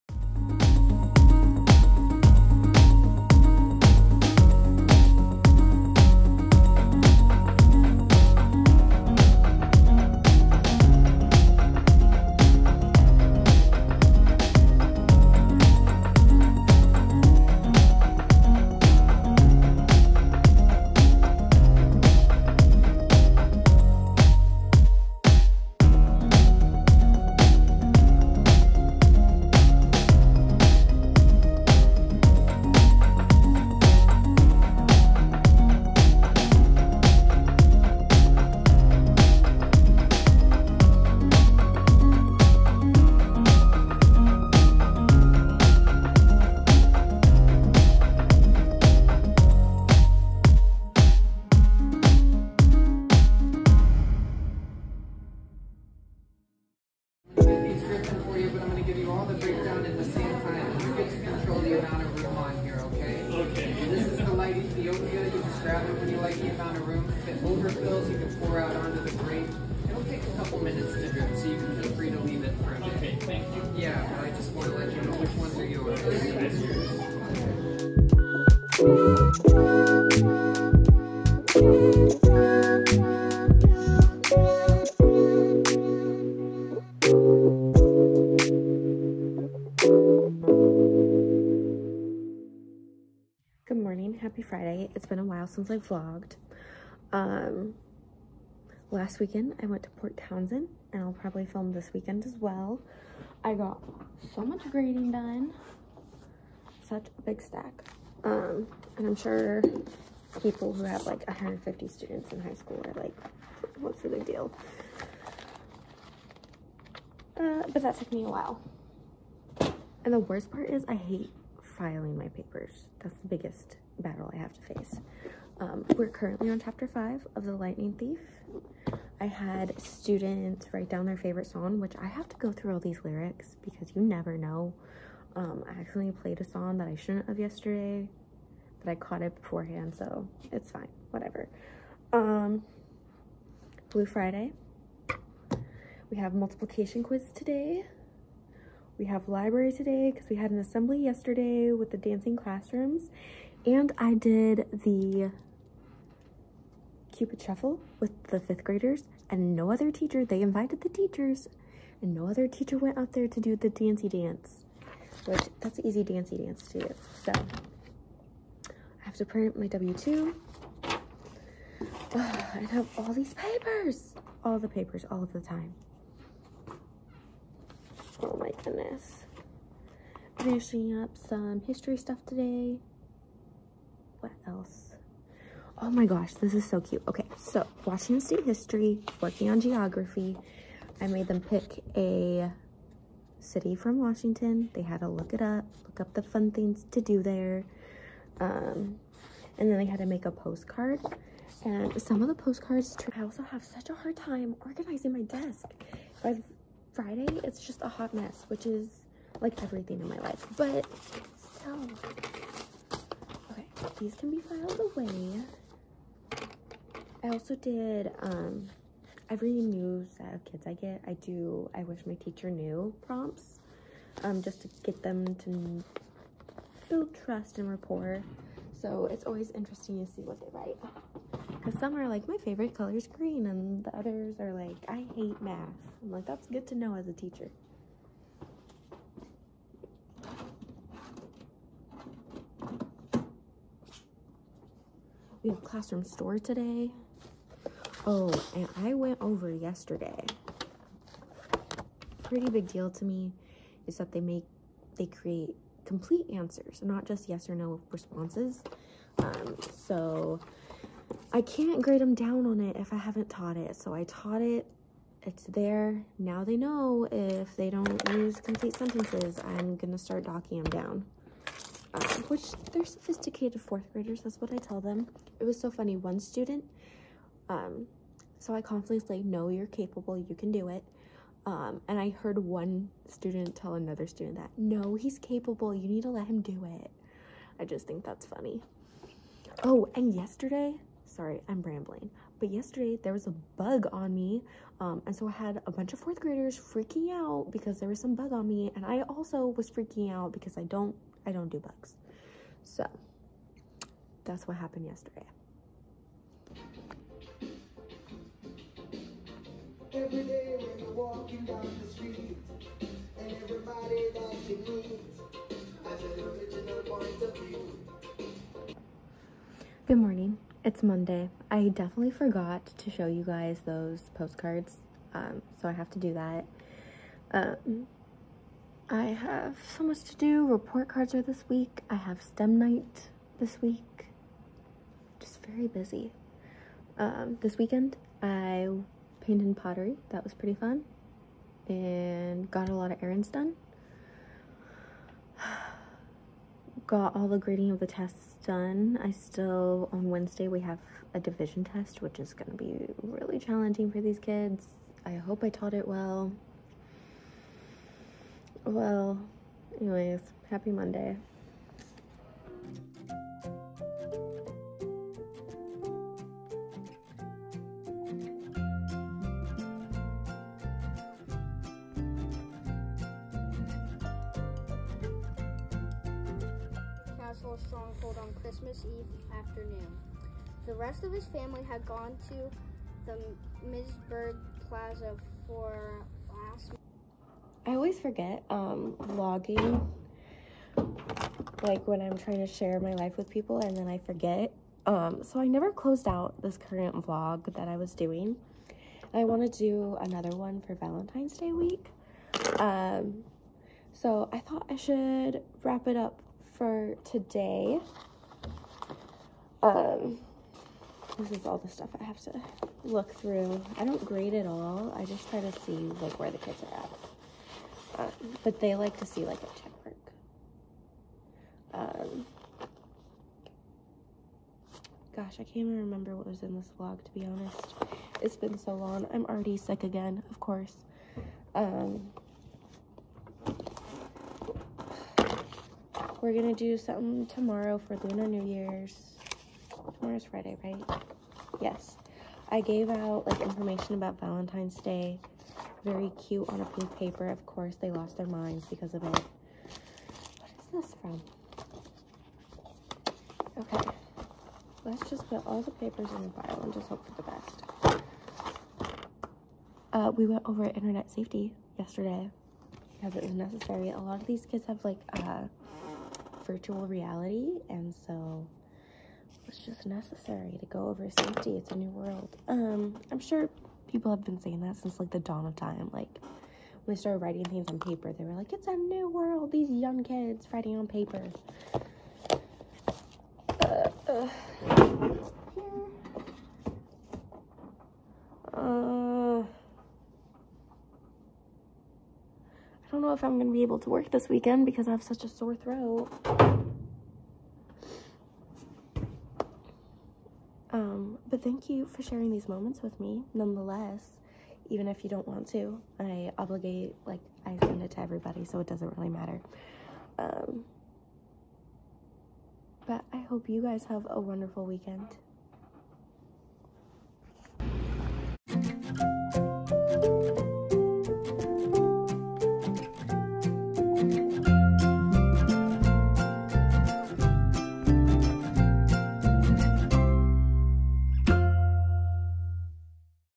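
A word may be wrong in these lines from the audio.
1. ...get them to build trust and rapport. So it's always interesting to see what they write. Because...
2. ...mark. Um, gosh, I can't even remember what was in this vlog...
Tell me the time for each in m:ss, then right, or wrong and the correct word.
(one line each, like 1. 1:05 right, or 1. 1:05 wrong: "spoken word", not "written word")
1. 3:44 right
2. 7:01 right.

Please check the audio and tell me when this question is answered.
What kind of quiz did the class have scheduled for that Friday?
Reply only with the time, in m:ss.
2:26.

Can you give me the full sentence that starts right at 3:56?
I'm like, that's good to know as a teacher.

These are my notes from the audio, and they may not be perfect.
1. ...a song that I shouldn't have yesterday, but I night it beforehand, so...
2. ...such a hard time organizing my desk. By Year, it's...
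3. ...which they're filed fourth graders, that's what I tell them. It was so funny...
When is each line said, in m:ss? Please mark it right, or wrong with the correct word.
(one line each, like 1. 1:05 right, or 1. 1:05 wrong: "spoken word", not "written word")
1. 2:16 wrong: "caught", not "night"
2. 3:23 wrong: "Friday", not "Year"
3. 4:32 wrong: "sophisticated", not "filed".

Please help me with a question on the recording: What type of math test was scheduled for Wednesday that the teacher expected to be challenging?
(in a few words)
Division test.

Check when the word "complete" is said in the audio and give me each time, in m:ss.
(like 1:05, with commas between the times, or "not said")
4:15, 4:28.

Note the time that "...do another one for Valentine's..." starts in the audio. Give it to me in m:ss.
6:39.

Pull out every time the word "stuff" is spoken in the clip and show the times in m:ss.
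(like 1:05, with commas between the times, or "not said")
3:01, 6:51.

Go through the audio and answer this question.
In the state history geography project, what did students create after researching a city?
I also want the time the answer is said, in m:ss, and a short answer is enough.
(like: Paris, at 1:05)
A postcard, at 3:20.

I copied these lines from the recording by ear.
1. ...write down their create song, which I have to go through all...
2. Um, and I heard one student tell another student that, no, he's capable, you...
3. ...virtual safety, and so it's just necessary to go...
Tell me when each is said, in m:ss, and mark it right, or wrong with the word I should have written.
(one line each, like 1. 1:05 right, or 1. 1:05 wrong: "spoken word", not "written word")
1. 2:10 wrong: "favorite", not "create"
2. 4:41 right
3. 7:46 wrong: "reality", not "safety".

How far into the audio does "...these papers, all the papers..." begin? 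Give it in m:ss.
2:53.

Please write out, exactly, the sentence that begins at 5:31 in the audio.
I have STEM night this week.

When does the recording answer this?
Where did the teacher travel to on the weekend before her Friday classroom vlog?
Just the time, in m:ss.
1:39.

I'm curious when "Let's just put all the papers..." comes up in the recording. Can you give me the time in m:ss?
7:34.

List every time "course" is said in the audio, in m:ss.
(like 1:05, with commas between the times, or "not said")
7:10, 7:27.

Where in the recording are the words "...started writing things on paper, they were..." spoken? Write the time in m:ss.
7:56.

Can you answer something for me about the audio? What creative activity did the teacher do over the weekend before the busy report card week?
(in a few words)
Painted pottery.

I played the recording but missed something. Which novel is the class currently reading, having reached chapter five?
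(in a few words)
The Lightning Thief.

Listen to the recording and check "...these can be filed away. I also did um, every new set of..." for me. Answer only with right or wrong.
right.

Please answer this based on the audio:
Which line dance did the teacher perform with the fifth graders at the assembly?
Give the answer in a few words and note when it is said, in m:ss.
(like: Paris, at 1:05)
Cupid Shuffle, at 2:37.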